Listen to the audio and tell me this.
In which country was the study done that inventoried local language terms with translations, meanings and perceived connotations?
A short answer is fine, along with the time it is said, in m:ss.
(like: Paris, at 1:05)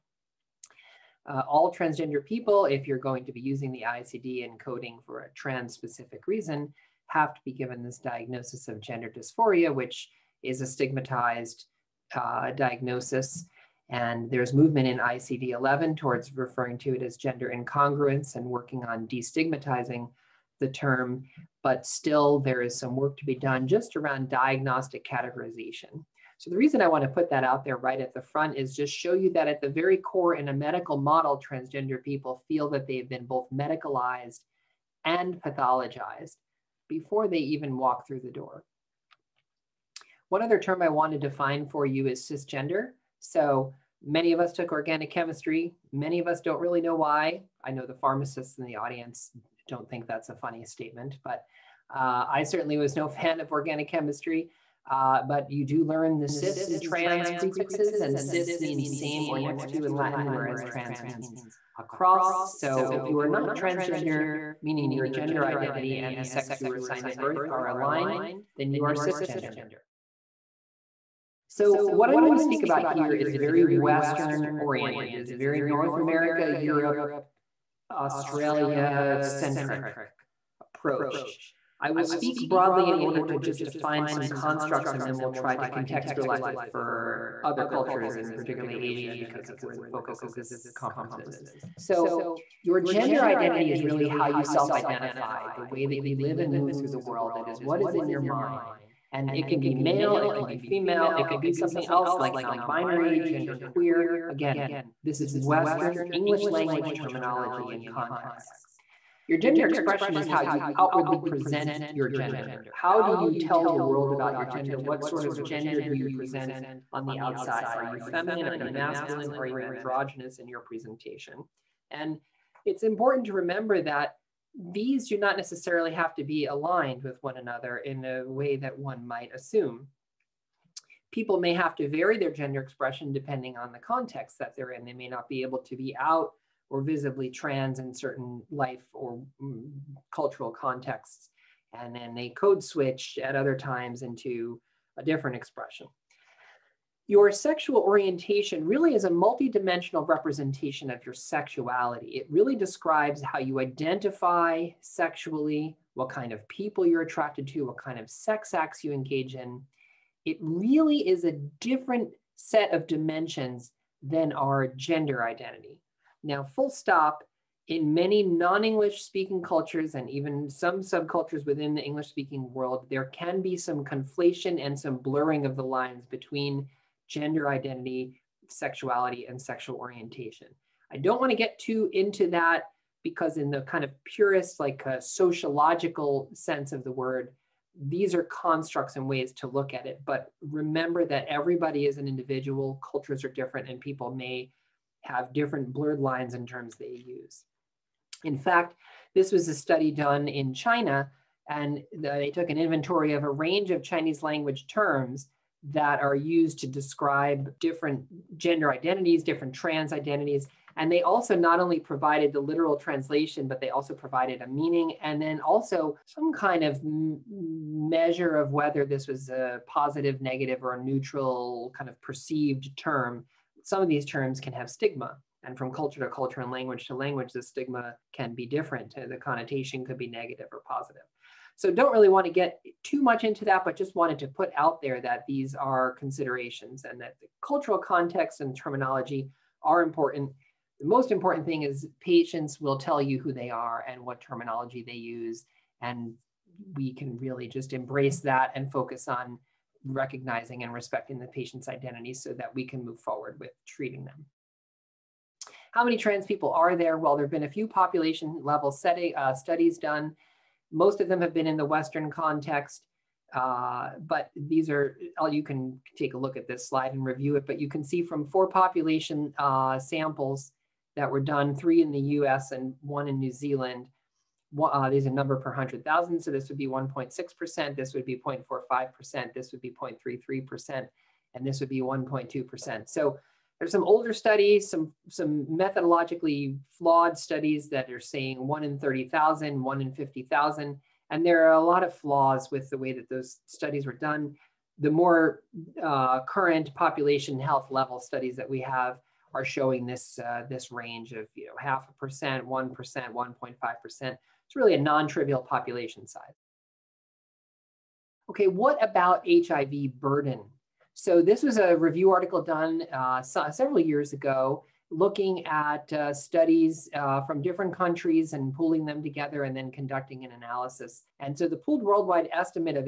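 China, at 3:20.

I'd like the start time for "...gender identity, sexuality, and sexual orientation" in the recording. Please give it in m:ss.
2:57.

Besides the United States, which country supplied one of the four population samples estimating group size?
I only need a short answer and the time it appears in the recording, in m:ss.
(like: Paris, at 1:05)
New Zealand, at 4:33.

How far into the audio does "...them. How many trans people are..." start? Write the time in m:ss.
4:14.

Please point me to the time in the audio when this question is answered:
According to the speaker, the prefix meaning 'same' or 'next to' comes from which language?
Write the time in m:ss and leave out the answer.
0:59.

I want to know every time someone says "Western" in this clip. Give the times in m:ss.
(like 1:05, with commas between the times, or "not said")
1:13, 1:45, 4:21.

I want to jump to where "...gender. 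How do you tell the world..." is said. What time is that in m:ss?
1:52.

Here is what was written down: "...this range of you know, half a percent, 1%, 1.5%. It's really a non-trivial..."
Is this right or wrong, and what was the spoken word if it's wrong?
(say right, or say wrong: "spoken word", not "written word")
right.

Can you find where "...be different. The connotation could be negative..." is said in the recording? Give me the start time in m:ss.
3:48.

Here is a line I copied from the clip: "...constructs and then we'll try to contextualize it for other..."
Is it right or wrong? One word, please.
right.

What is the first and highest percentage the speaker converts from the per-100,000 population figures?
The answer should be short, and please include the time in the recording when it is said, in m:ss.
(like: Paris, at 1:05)
1.6%, at 4:36.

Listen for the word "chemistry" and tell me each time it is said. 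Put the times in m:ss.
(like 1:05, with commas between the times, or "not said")
0:45, 0:53.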